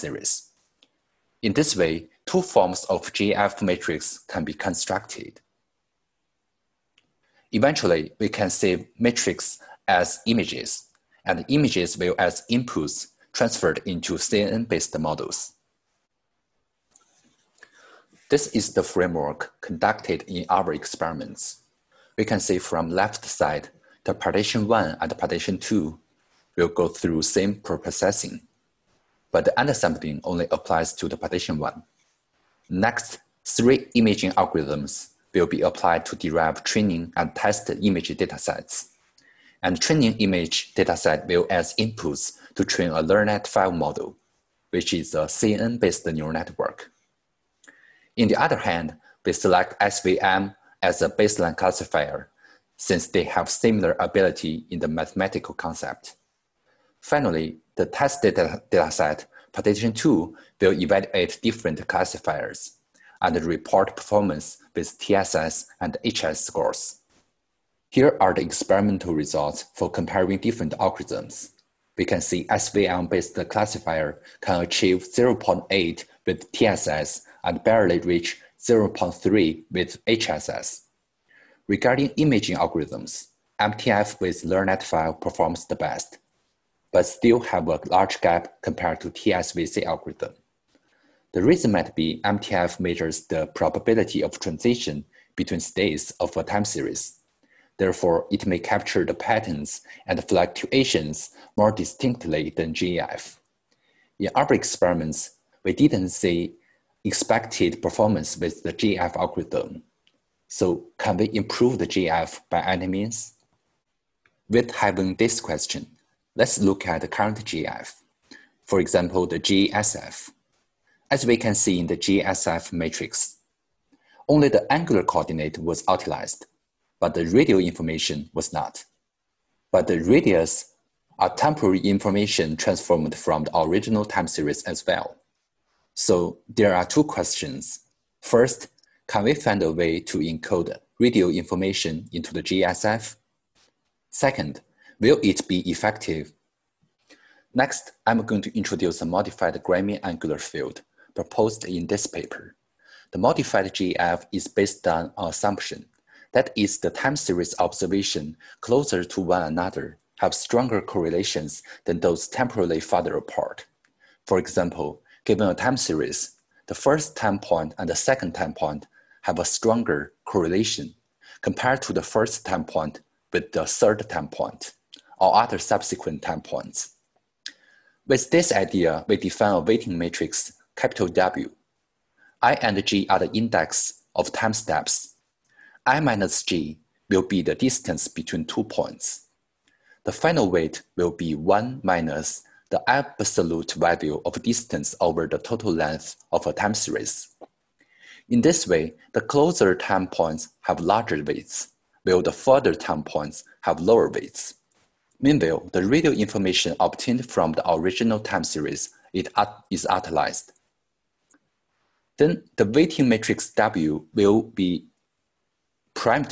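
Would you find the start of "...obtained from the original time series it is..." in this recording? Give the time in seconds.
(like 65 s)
206 s.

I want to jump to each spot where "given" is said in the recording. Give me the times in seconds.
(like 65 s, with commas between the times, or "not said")
165 s.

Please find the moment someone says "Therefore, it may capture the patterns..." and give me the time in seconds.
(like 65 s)
97 s.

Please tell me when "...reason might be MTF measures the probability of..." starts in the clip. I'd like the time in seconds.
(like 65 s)
91 s.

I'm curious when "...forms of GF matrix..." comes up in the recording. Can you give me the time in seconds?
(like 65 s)
2 s.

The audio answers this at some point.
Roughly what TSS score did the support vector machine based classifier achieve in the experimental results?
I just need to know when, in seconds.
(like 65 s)
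75 s.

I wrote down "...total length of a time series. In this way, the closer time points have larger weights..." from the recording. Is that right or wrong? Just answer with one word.
right.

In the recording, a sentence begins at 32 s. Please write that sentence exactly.
Next, three imaging algorithms will be applied to derive training and test image datasets.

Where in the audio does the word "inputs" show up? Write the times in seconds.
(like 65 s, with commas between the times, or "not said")
12 s, 41 s.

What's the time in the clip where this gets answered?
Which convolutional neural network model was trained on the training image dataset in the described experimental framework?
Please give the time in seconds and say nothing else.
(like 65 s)
43 s.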